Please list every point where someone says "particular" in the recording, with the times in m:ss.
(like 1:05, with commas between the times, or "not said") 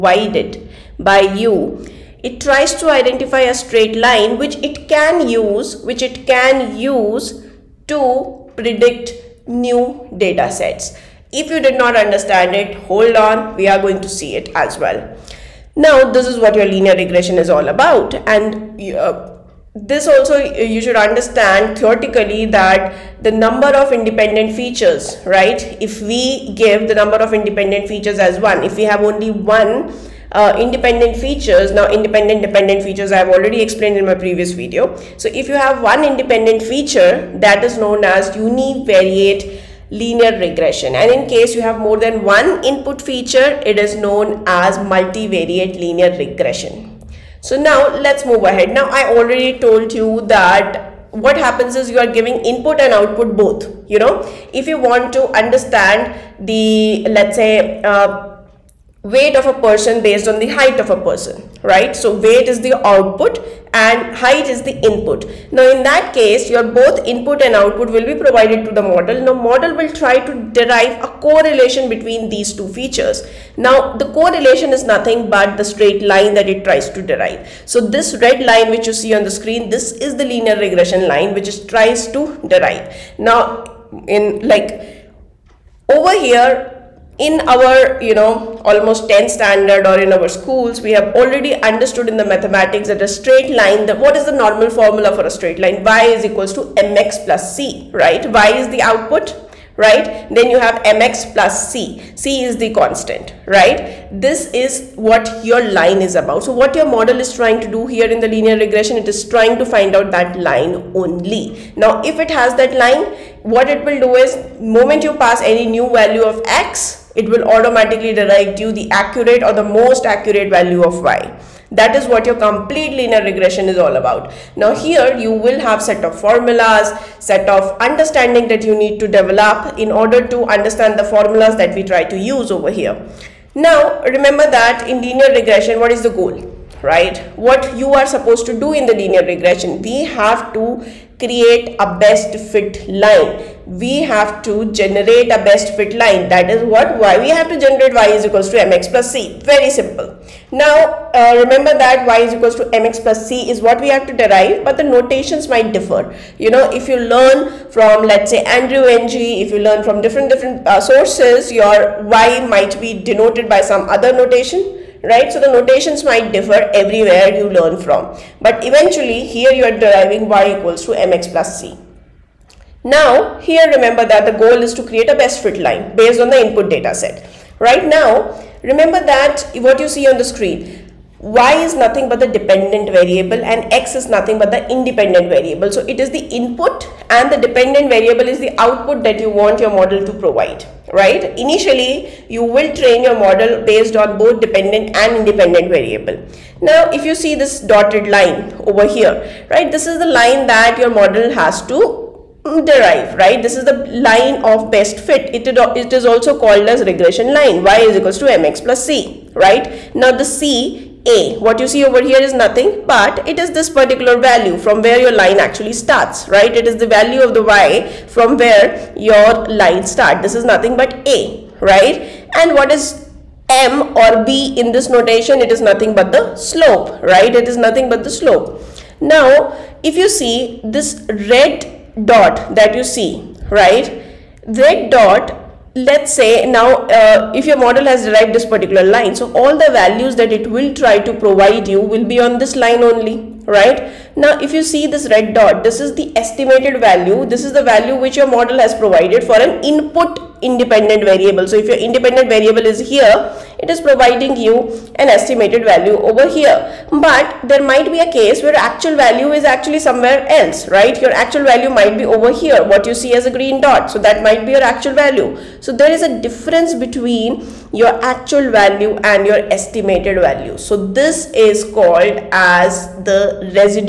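3:33, 3:58.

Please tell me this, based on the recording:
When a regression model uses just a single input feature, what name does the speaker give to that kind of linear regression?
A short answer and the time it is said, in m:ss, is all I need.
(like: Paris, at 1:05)
univariate linear regression, at 0:38.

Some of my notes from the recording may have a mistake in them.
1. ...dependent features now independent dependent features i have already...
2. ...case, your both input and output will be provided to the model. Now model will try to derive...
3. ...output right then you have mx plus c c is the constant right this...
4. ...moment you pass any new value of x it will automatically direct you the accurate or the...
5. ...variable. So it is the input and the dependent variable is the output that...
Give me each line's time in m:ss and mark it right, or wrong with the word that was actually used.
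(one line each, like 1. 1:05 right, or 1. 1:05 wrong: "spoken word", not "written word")
1. 0:30 wrong: "independent", not "dependent"
2. 1:06 right
3. 1:38 right
4. 1:54 right
5. 3:05 right.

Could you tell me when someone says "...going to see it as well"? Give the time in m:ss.
0:13.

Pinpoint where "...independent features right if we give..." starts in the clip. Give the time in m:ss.
0:23.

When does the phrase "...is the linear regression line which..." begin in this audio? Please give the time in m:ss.
1:19.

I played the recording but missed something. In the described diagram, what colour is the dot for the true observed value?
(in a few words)
green.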